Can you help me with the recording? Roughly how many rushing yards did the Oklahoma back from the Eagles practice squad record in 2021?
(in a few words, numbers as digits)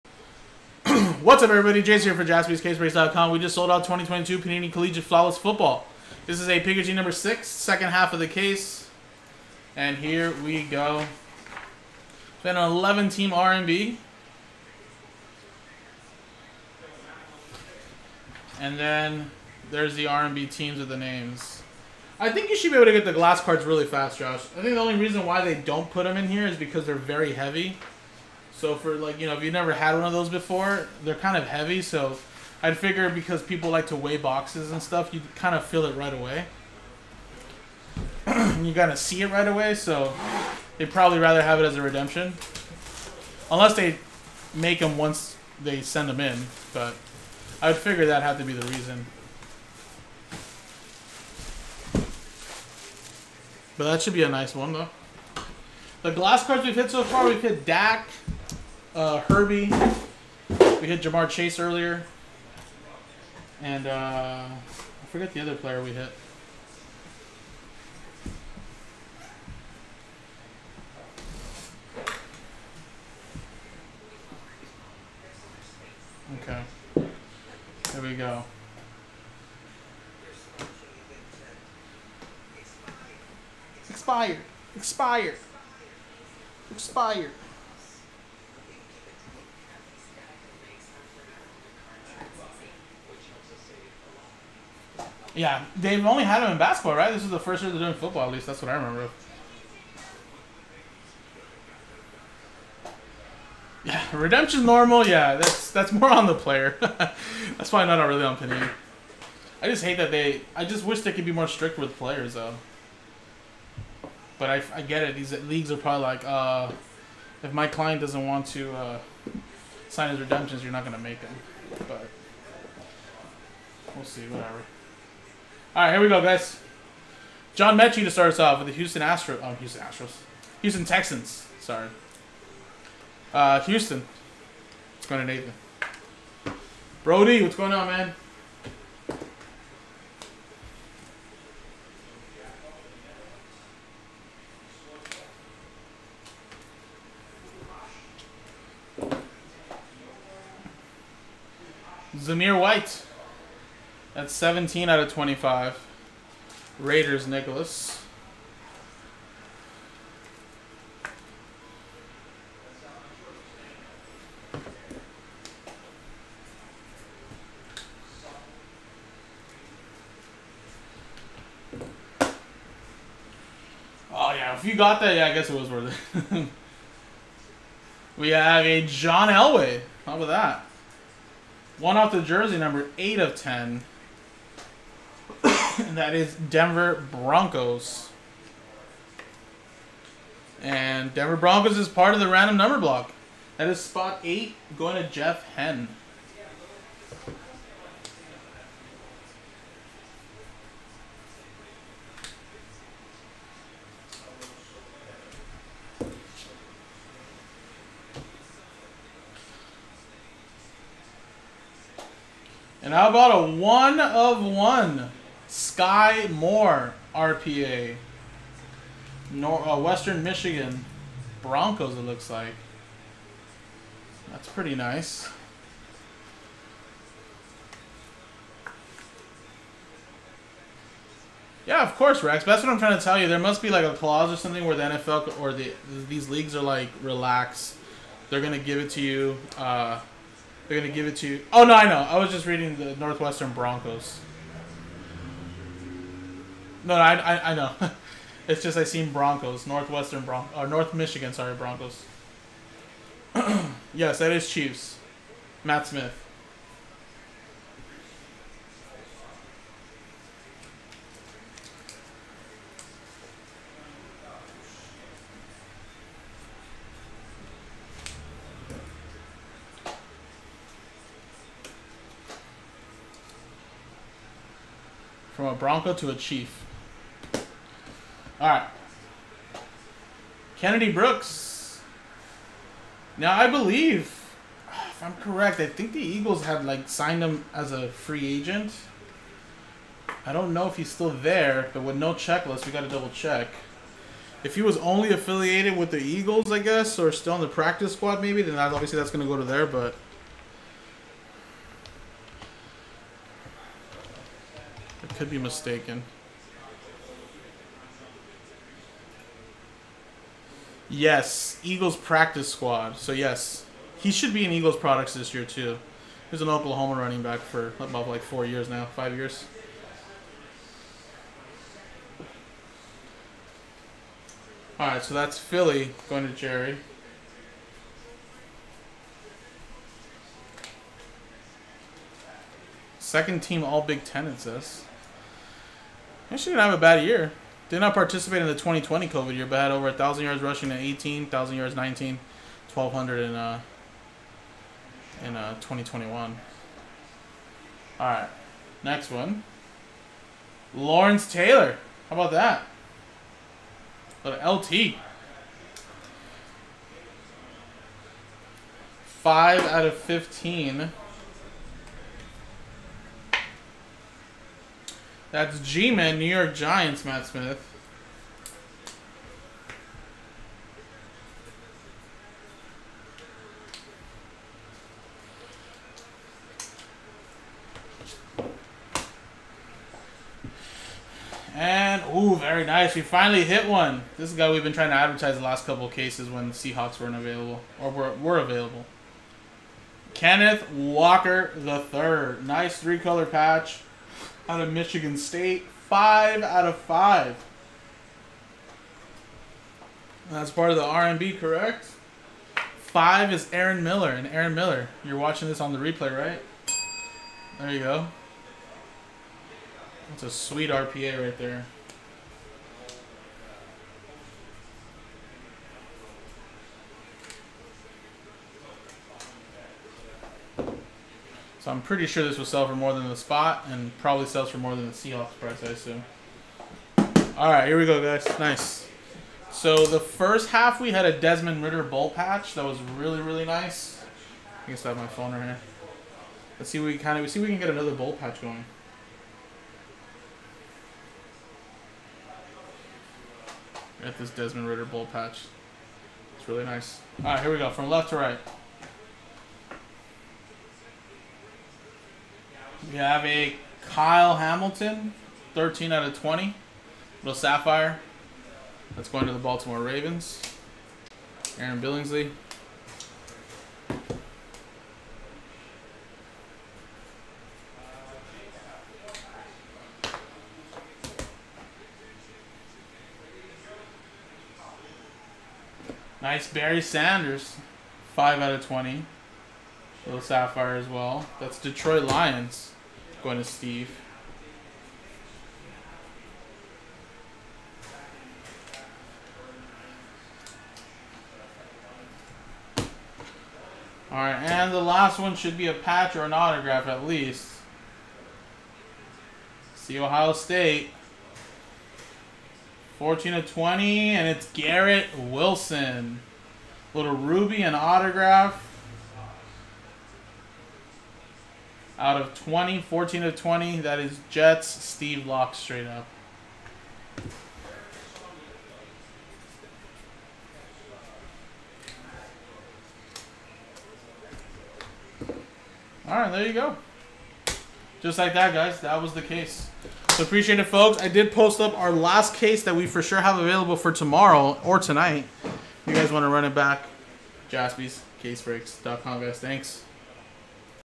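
1,200.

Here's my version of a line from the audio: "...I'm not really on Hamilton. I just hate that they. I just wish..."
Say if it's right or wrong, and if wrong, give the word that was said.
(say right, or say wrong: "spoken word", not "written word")
wrong: "Panini", not "Hamilton".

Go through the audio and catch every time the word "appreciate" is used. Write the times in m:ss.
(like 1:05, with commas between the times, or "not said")
8:50.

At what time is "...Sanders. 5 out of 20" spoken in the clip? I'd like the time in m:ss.
7:56.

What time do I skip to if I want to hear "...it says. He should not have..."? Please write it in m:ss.
5:34.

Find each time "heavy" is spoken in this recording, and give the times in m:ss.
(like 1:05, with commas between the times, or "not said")
0:27, 0:31.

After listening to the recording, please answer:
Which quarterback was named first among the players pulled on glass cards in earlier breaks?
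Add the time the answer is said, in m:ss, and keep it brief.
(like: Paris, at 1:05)
Dak, at 0:57.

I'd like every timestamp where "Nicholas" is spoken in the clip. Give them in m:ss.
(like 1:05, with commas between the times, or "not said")
2:37.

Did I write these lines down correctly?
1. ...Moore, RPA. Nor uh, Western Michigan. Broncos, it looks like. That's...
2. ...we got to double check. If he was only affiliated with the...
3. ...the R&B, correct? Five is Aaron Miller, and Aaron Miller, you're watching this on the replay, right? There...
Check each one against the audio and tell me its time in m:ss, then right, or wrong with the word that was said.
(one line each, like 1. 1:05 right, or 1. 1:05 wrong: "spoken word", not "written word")
1. 3:36 right
2. 4:52 right
3. 6:40 right.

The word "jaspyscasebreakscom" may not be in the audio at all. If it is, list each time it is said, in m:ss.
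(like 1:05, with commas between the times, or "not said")
0:02, 8:57.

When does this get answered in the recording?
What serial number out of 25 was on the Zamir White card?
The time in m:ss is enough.
2:34.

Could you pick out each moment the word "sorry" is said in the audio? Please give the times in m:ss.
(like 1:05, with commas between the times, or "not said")
2:11, 4:11.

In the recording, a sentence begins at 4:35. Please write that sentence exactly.
From a Bronco to a Chief.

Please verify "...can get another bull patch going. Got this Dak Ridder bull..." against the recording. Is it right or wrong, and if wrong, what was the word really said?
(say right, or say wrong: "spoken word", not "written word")
wrong: "Desmond", not "Dak".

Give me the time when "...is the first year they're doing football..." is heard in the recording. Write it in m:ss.
1:37.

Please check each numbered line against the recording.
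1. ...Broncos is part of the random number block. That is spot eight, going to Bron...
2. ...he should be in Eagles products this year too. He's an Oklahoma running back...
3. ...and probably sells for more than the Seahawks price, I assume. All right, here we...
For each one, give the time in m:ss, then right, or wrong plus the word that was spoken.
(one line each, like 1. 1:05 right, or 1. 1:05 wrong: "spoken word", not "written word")
1. 3:11 wrong: "Jeff", not "Bron"
2. 5:13 right
3. 7:03 right.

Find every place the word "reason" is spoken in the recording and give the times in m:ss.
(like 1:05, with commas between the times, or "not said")
0:24, 0:48.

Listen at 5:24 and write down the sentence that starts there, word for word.
All right, so that's Philly going to Jerry.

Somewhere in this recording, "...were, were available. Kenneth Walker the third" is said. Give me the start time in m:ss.
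6:27.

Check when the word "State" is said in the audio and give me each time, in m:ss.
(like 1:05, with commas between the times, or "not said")
6:35, 8:20.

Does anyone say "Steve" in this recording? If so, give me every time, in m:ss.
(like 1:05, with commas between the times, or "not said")
8:03, 8:34.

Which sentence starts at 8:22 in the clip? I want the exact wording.
14 to 20, and it's Garrett Wilson.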